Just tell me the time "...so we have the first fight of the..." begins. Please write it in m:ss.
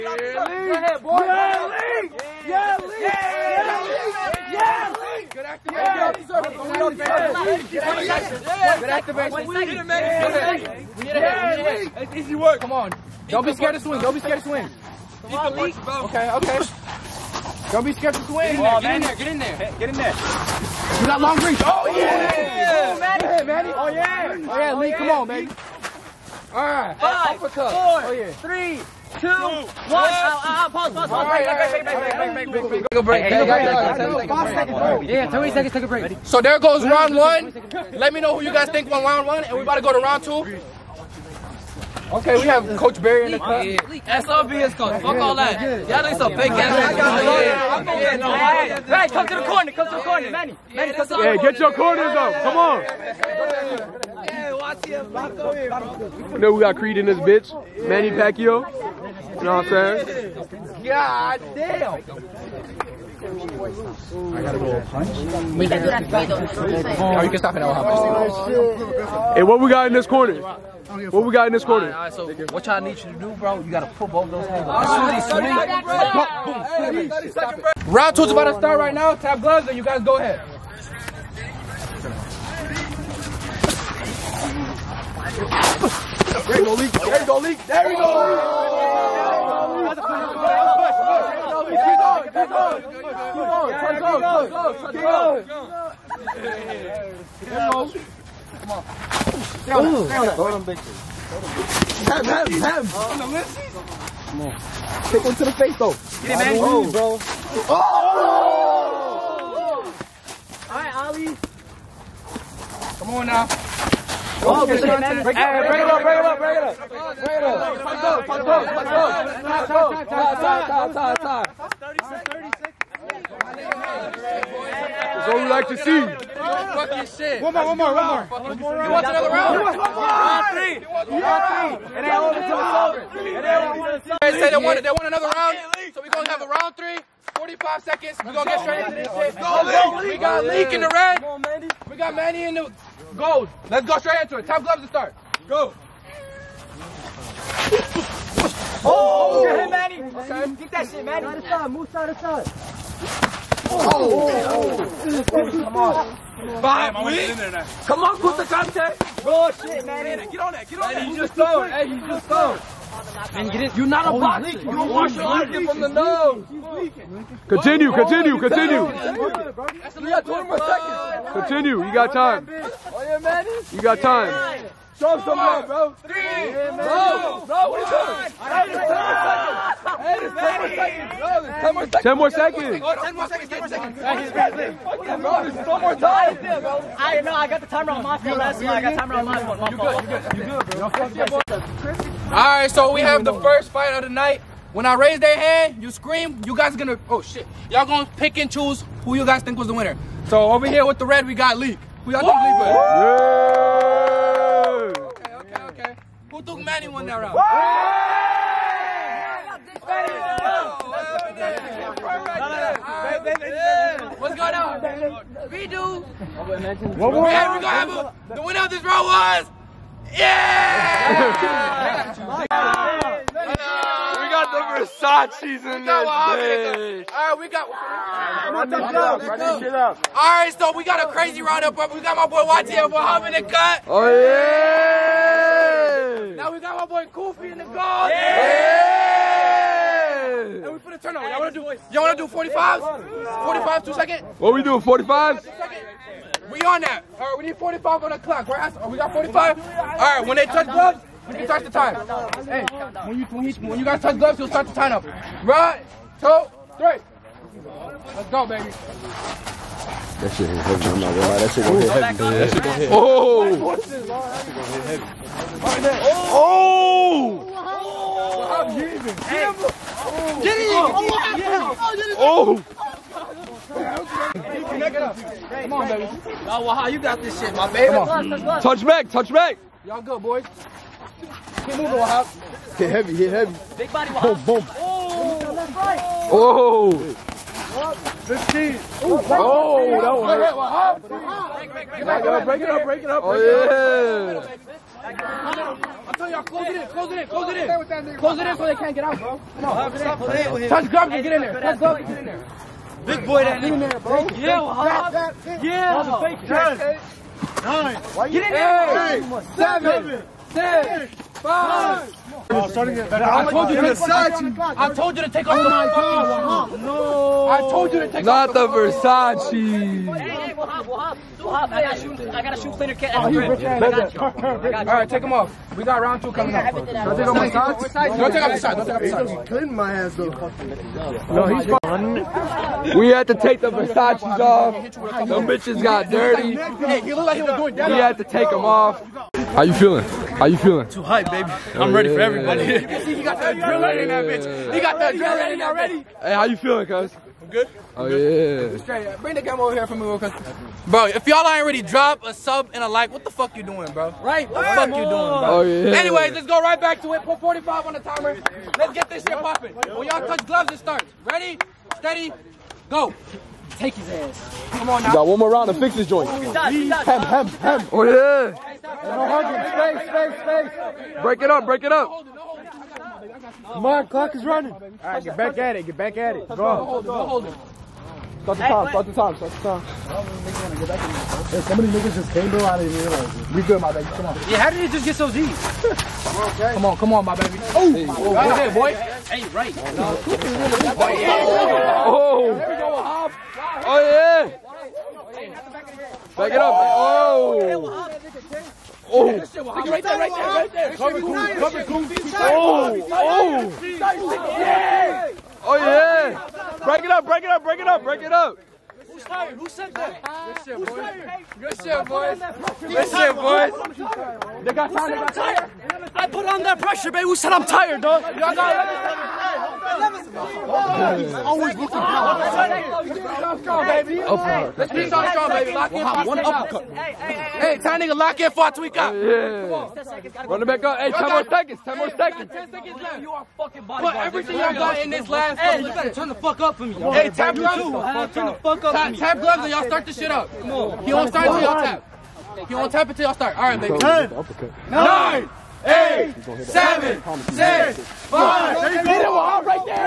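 3:12.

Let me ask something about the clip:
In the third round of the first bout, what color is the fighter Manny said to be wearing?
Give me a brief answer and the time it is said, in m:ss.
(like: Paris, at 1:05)
gold, at 2:21.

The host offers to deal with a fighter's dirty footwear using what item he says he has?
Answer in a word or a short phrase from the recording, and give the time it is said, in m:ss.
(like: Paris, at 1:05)
shoe cleaner kit, at 5:22.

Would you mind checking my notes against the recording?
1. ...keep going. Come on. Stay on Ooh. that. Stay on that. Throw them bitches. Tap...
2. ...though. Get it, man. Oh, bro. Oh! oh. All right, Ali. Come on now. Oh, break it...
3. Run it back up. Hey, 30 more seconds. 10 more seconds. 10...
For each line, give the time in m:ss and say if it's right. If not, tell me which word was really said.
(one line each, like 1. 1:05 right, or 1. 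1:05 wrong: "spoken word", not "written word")
1. 1:37 right
2. 1:45 right
3. 7:10 wrong: "10", not "30".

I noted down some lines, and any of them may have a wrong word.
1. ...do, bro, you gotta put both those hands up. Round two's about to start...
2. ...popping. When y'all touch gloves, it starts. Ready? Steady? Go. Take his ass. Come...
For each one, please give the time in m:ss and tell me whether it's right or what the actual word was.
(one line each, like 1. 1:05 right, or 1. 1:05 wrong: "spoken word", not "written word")
1. 1:13 right
2. 5:59 right.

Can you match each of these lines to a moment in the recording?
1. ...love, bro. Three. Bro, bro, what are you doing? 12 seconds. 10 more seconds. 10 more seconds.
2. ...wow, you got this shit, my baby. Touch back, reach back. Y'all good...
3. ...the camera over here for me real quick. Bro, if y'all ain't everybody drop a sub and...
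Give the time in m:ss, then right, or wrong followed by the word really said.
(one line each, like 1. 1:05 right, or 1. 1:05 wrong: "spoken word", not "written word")
1. 2:55 wrong: "10", not "12"
2. 4:36 wrong: "touch", not "reach"
3. 5:49 wrong: "already", not "everybody".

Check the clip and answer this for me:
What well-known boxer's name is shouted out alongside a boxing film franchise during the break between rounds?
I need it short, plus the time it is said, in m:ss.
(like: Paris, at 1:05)
Manny Pacquiao, at 0:57.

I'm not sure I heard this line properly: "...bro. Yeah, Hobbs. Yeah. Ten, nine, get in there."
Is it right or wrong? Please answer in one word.
right.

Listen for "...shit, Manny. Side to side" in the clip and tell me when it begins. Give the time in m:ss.
2:30.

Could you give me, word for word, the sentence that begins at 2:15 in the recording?
So we're going to have a round three.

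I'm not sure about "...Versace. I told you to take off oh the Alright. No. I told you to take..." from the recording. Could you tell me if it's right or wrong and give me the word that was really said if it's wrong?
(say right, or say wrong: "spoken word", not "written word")
wrong: "Versace", not "Alright".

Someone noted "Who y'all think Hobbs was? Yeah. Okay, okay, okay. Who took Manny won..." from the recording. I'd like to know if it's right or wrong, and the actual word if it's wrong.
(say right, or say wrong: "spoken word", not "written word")
wrong: "Leak", not "Hobbs".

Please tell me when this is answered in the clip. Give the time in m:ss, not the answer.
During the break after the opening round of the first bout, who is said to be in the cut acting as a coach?
0:42.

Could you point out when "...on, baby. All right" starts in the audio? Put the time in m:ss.
0:25.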